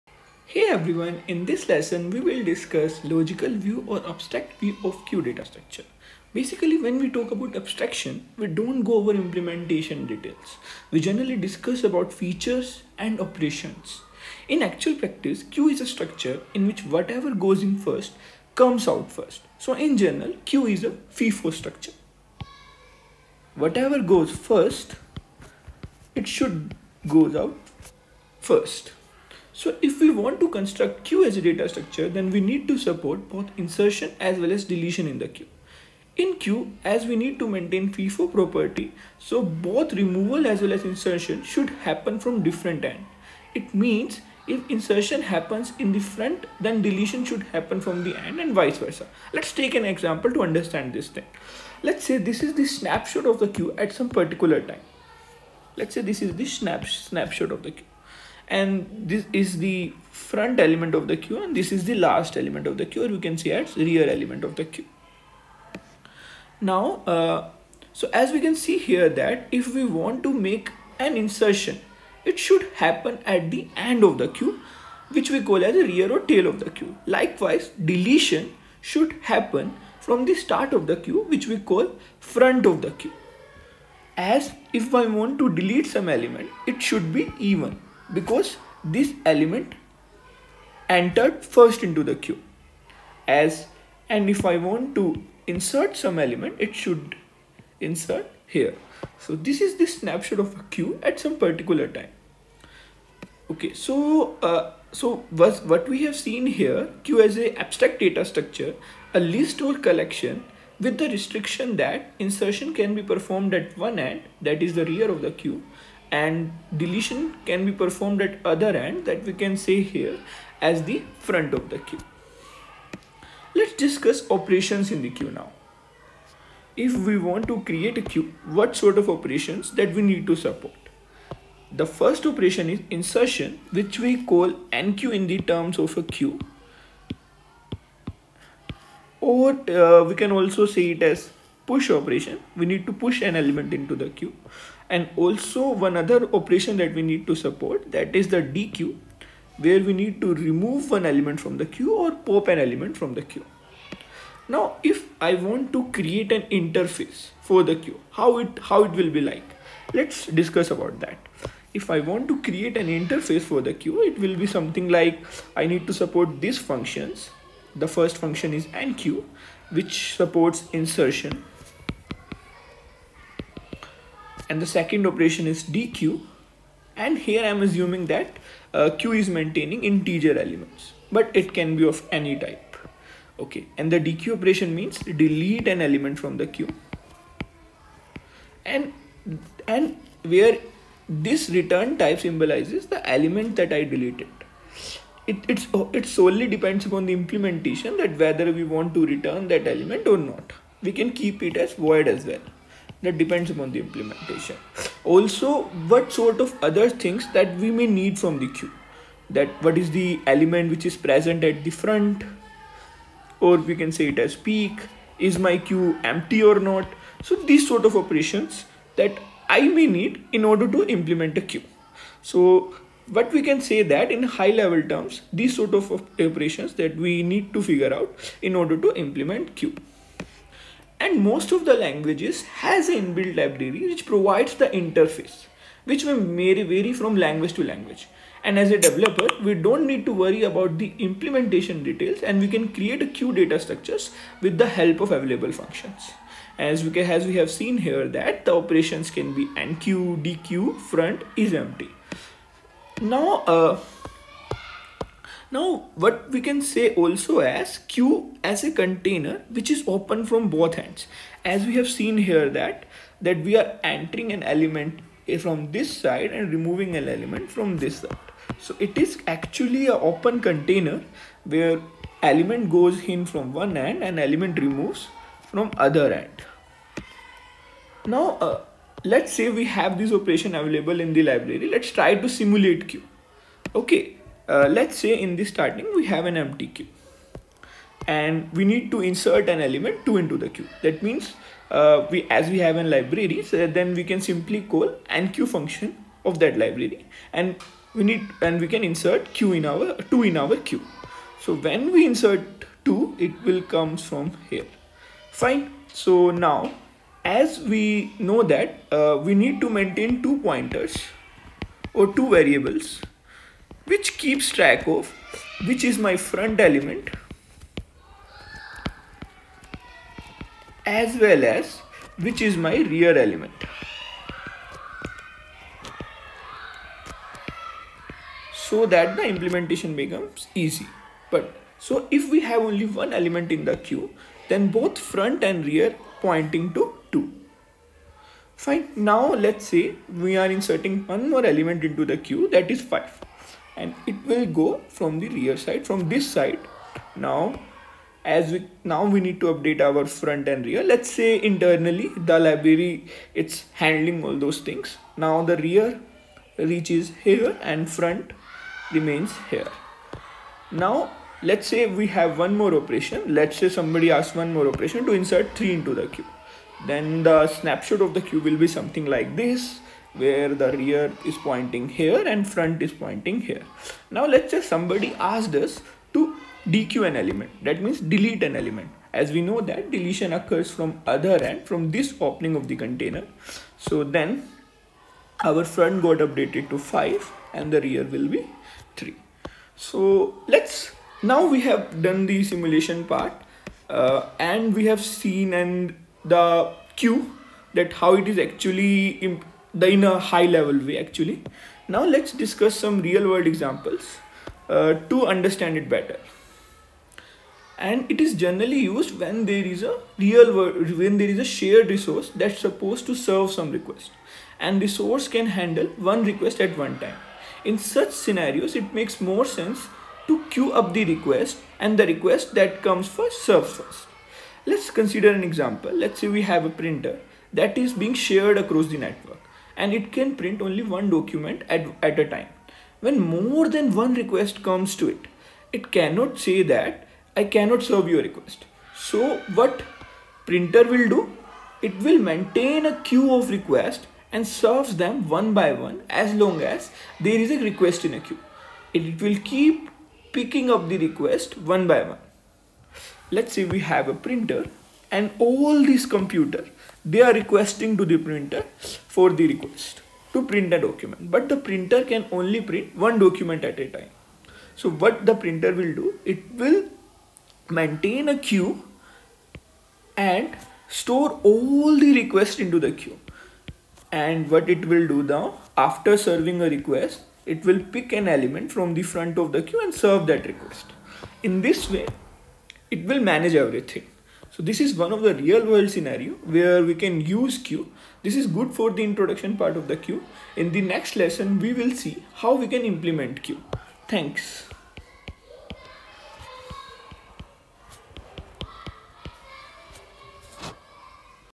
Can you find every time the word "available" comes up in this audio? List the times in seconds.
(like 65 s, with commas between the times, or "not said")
245 s, 280 s.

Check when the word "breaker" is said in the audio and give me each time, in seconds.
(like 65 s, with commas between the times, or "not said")
not said.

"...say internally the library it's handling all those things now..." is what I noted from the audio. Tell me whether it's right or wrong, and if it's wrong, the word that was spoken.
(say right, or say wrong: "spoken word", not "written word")
right.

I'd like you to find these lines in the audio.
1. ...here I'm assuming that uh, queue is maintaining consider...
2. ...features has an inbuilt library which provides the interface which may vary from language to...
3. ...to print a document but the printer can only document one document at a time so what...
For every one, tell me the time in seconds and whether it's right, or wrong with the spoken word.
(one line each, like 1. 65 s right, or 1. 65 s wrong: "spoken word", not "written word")
1. 177 s wrong: "integer", not "consider"
2. 231 s wrong: "languages", not "features"
3. 460 s wrong: "print", not "document".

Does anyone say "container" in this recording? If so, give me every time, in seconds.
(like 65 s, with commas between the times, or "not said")
258 s, 270 s, 382 s.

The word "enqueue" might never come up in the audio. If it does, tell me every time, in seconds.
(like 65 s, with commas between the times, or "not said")
134 s, 168 s, 249 s.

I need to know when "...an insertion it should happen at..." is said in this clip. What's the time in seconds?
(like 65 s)
71 s.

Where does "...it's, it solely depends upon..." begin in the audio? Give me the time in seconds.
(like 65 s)
195 s.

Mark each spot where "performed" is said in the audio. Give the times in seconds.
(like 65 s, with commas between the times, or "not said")
113 s, 117 s.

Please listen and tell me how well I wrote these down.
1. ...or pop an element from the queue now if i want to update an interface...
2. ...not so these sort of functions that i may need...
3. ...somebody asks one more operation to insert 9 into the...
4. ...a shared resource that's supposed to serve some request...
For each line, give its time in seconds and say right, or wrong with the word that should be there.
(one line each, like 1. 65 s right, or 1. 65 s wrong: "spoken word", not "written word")
1. 151 s wrong: "create", not "update"
2. 216 s wrong: "operations", not "functions"
3. 363 s wrong: "3", not "9"
4. 411 s right.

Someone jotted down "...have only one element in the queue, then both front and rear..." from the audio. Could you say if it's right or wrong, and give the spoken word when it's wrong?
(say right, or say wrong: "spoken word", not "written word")
right.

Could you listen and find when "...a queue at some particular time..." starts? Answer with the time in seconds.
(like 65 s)
100 s.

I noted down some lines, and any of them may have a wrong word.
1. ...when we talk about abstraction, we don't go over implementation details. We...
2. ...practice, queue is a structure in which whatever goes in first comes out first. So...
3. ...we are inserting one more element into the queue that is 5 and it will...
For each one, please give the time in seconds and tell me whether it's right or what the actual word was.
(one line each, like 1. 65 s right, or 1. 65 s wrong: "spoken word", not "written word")
1. 6 s right
2. 14 s right
3. 340 s right.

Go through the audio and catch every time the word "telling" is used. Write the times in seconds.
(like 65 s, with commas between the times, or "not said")
not said.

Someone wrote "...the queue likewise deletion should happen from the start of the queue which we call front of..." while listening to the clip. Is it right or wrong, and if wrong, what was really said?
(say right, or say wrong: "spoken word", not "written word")
right.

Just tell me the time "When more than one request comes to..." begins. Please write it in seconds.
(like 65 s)
432 s.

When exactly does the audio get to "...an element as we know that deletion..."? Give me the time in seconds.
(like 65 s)
378 s.